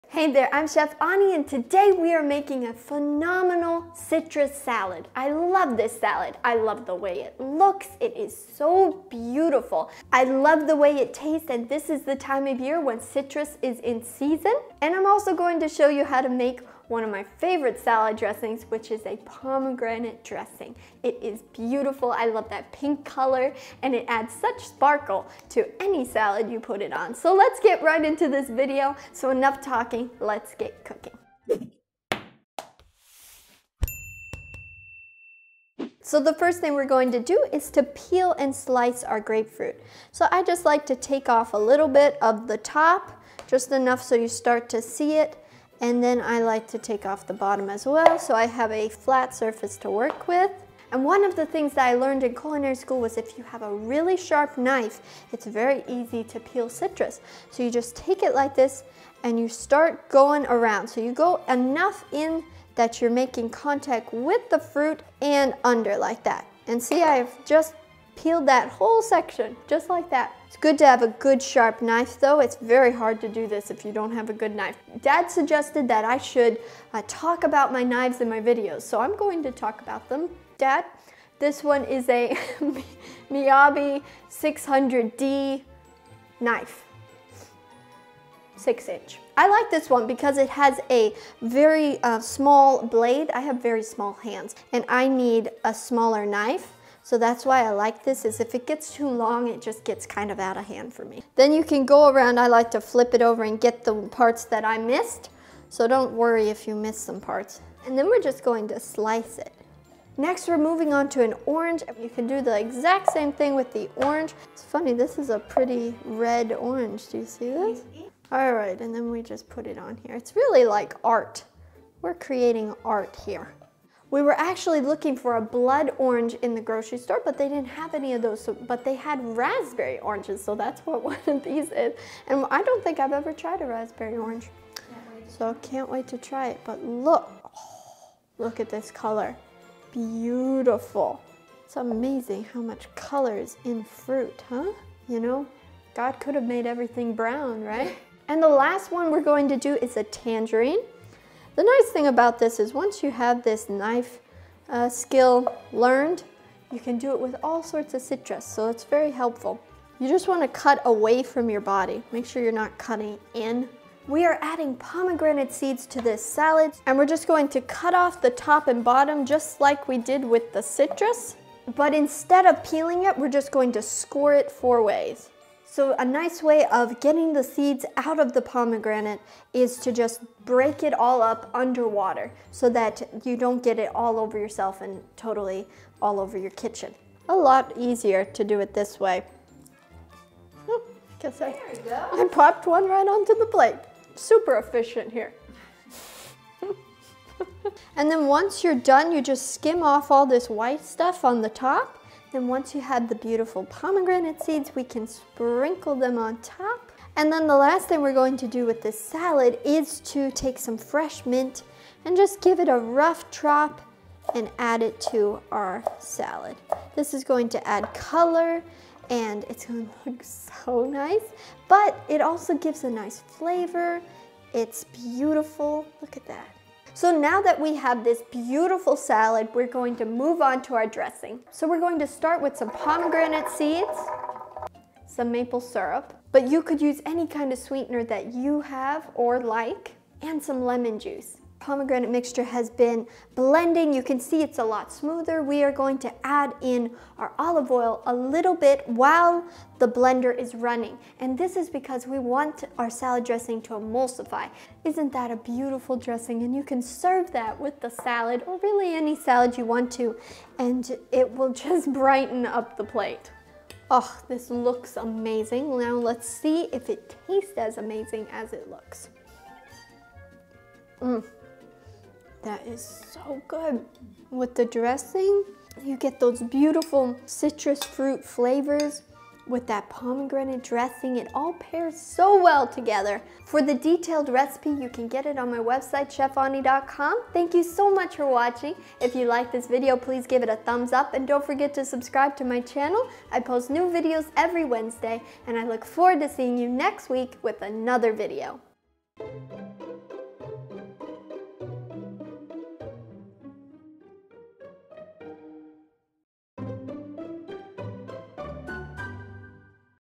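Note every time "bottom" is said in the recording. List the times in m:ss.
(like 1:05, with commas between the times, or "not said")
0:47, 2:48.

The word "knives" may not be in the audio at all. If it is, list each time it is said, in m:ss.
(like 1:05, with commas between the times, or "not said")
1:17.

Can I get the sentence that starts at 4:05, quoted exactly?
We are going to add in our olive oil a little bit while the blender is running.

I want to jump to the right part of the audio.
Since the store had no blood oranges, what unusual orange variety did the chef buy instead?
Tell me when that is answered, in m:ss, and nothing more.
2:09.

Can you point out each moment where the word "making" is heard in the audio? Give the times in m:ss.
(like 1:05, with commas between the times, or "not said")
0:02, 1:03.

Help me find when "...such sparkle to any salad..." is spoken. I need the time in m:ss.
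0:24.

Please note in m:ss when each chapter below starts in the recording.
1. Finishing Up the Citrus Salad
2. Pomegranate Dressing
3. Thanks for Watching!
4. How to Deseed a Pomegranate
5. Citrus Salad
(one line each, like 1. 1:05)
1. 3:26
2. 3:46
3. 4:43
4. 2:44
5. 0:33.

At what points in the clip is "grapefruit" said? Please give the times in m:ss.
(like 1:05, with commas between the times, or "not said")
0:39.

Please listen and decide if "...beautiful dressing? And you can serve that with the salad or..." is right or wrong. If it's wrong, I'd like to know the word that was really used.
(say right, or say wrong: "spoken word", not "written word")
right.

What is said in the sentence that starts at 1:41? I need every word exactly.
Then you can go around, I like to flip it over and get the parts that I missed.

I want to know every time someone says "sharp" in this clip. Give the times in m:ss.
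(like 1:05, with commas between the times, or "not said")
0:54, 1:11.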